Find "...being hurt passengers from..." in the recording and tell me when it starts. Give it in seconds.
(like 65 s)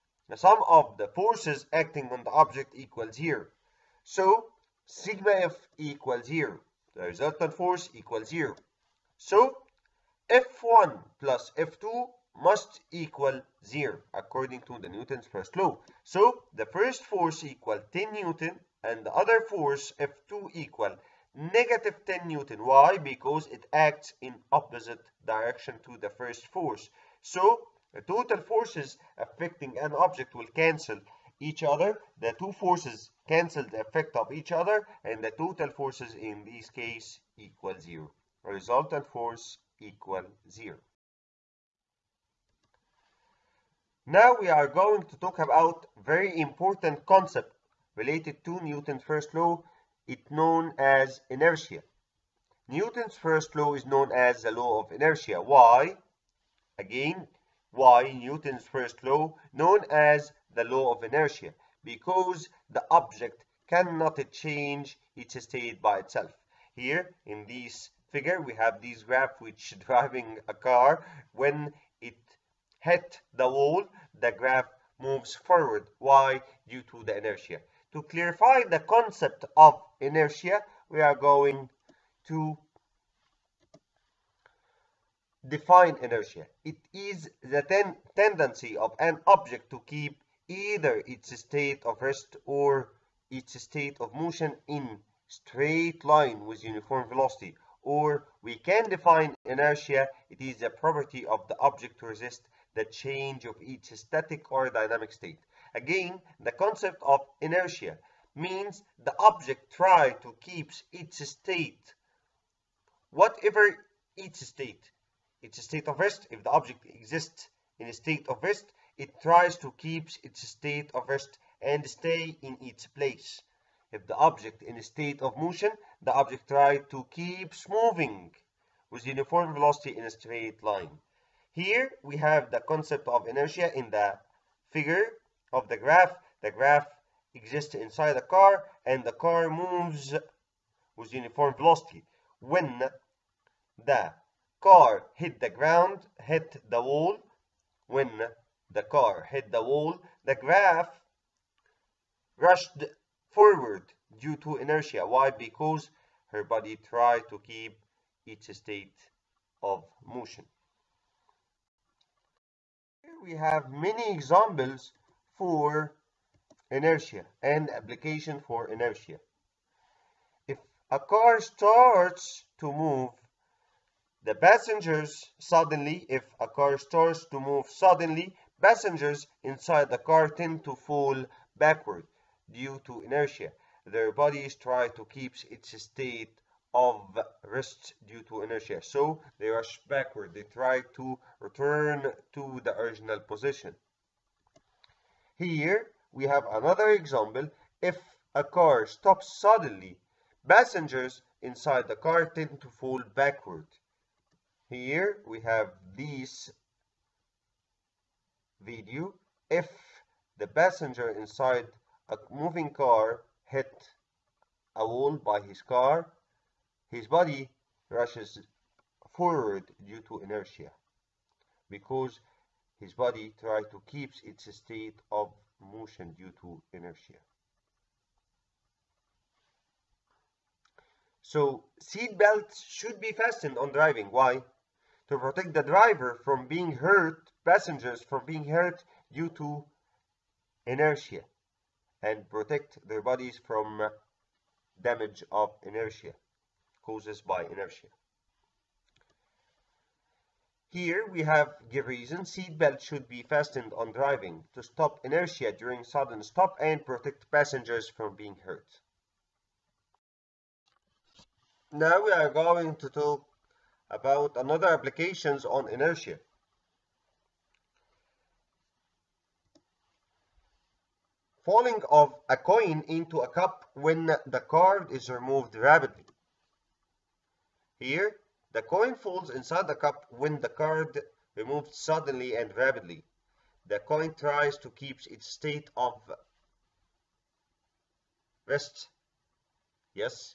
236 s.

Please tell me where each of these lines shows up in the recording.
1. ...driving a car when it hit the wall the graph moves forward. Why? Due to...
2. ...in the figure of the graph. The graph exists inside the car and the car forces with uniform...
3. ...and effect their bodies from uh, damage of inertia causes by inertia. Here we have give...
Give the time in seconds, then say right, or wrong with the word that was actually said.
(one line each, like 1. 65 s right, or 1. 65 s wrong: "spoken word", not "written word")
1. 69 s right
2. 133 s wrong: "moves", not "forces"
3. 242 s wrong: "protect", not "effect".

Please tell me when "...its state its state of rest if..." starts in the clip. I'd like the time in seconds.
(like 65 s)
114 s.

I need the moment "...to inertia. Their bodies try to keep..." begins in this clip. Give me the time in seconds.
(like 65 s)
182 s.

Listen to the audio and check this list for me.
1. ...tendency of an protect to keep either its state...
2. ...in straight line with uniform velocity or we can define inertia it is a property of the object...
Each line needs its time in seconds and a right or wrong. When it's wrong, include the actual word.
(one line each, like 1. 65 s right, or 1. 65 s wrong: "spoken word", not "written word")
1. 88 s wrong: "object", not "protect"
2. 94 s right.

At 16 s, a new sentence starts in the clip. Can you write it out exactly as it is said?
So the first force equal 10 Newton and the other force F2 equal negative 10 Newton.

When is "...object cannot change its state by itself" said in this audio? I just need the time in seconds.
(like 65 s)
62 s.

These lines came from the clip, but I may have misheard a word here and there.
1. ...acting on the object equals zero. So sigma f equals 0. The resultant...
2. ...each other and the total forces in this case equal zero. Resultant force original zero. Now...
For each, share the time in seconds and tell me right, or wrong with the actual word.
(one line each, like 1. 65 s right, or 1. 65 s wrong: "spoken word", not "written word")
1. 1 s right
2. 34 s wrong: "equal", not "original".